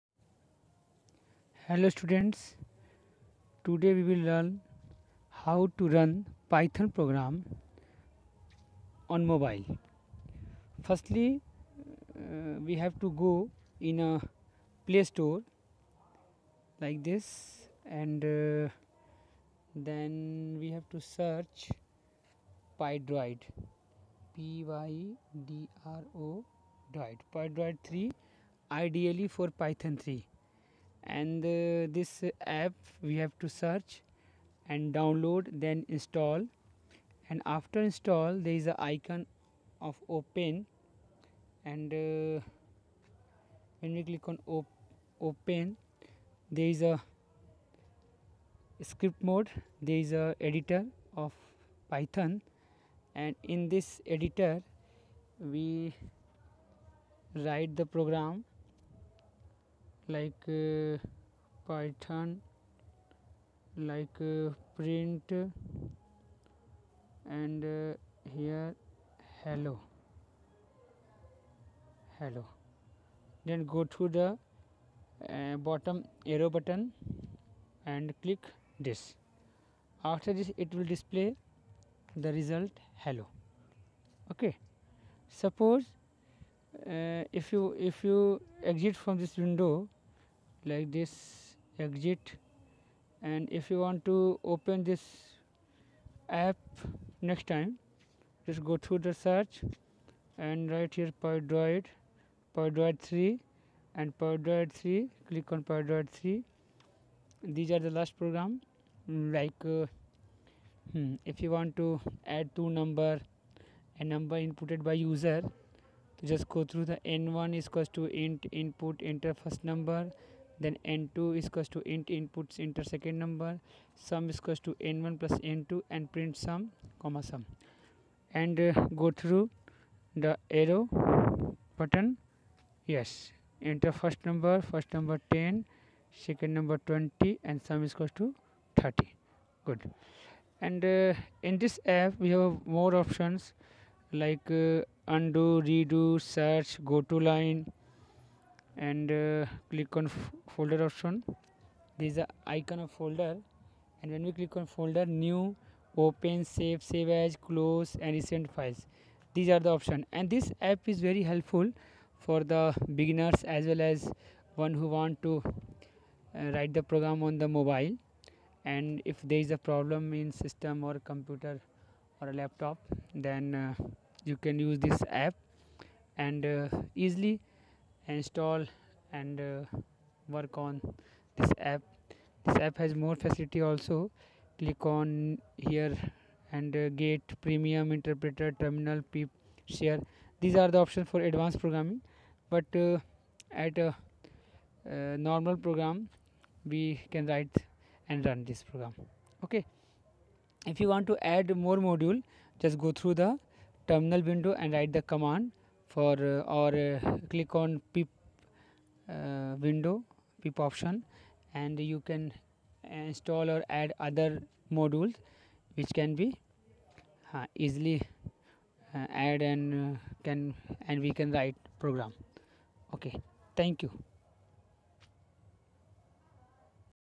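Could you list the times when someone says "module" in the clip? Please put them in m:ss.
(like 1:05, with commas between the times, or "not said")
3:21, 3:34.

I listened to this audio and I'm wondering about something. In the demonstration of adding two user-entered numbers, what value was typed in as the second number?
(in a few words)
20.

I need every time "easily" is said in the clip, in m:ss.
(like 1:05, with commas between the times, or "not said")
2:56, 3:37.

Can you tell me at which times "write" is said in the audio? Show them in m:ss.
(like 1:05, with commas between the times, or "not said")
0:57, 2:46, 3:17, 3:24, 3:41.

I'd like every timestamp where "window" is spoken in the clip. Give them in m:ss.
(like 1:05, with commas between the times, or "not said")
1:29, 3:24, 3:29.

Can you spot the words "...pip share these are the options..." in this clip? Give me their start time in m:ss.
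3:09.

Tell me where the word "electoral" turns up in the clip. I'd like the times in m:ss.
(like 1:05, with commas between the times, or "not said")
not said.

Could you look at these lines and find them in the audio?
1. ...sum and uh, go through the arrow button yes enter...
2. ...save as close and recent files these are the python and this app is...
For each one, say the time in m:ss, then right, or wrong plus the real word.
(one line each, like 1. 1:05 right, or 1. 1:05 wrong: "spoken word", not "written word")
1. 2:07 right
2. 2:36 wrong: "option", not "python".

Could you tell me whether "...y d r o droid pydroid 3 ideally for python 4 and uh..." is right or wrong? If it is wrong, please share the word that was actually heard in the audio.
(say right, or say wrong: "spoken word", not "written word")
wrong: "3", not "4".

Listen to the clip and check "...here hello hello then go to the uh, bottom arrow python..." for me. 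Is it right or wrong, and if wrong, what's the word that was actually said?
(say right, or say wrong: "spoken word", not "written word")
wrong: "button", not "python".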